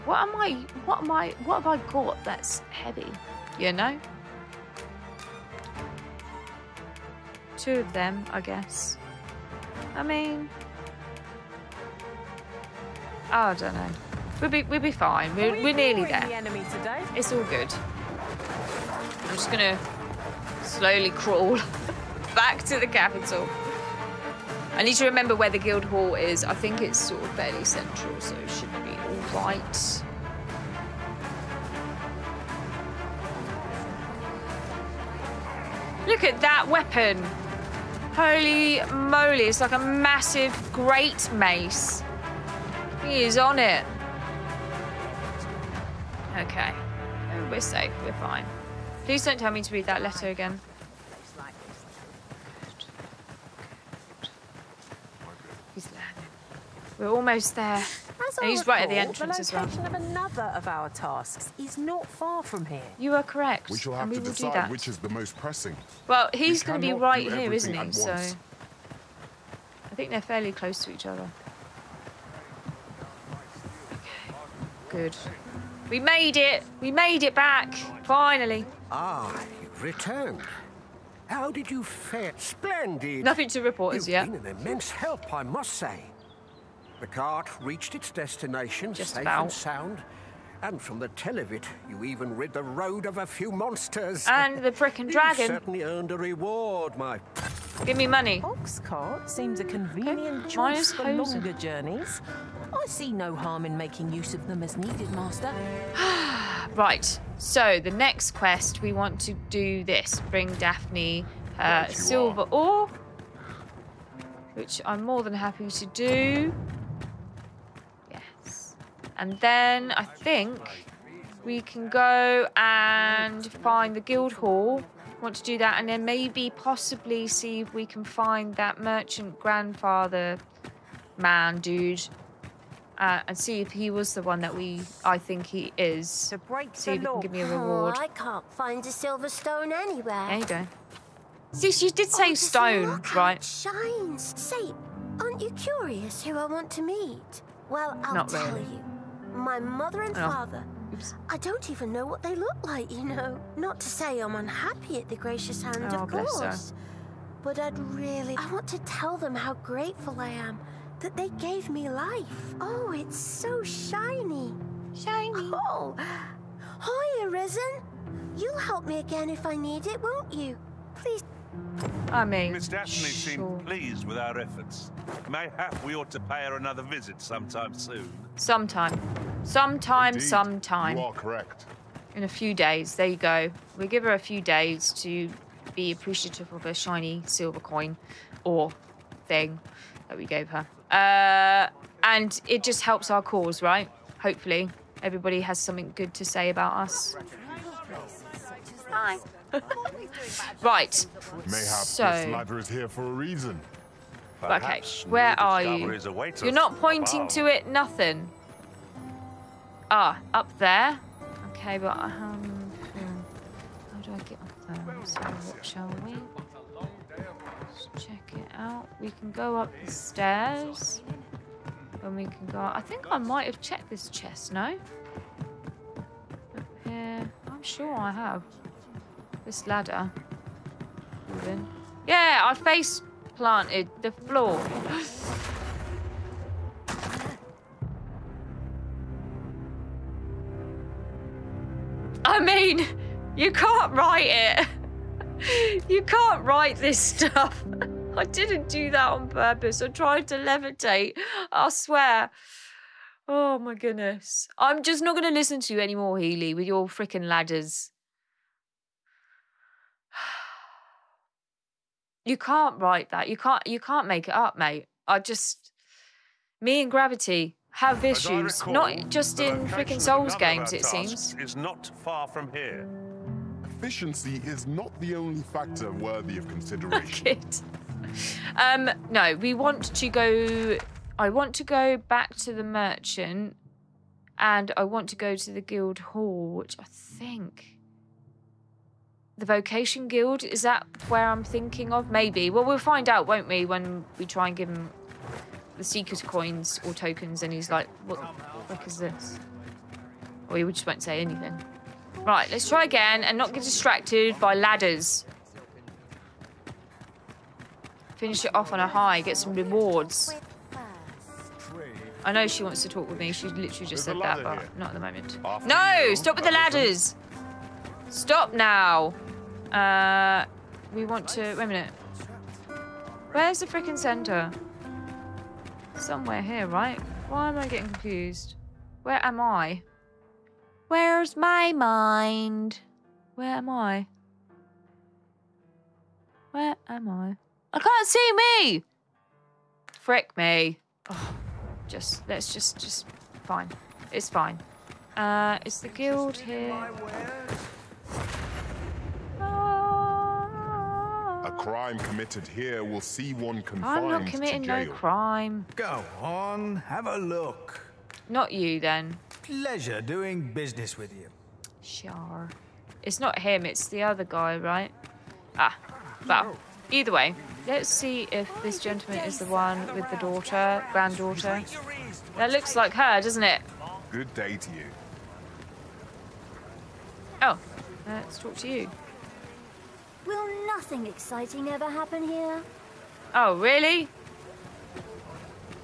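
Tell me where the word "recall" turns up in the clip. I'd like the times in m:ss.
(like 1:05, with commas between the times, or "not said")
0:58, 4:28.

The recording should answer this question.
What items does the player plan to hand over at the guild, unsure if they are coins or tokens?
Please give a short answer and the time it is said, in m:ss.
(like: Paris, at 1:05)
Seeker's coins, at 4:55.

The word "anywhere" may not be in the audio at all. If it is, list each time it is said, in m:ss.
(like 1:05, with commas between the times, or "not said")
2:19.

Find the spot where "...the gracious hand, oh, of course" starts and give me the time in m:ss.
2:35.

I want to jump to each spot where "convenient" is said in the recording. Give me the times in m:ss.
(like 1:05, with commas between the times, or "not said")
1:39.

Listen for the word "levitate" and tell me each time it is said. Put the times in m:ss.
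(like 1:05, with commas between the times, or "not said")
4:10.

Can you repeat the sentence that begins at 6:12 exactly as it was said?
That looks like her, doesn't it?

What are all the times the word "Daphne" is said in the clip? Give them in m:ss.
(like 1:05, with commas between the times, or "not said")
1:50, 2:52.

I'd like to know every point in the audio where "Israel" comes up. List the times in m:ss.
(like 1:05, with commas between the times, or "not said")
not said.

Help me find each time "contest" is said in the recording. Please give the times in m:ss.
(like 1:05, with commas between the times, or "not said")
not said.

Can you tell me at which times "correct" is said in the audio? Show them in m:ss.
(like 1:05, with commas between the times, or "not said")
1:03, 3:01.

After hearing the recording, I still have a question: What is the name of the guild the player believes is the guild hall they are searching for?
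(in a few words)
Vocation Guild.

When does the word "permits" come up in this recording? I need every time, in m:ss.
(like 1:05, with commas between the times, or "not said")
not said.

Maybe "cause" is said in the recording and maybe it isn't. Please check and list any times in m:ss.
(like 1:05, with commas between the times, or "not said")
3:13.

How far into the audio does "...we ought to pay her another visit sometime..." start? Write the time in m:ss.
2:55.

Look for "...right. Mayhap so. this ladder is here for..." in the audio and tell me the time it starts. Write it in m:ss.
3:20.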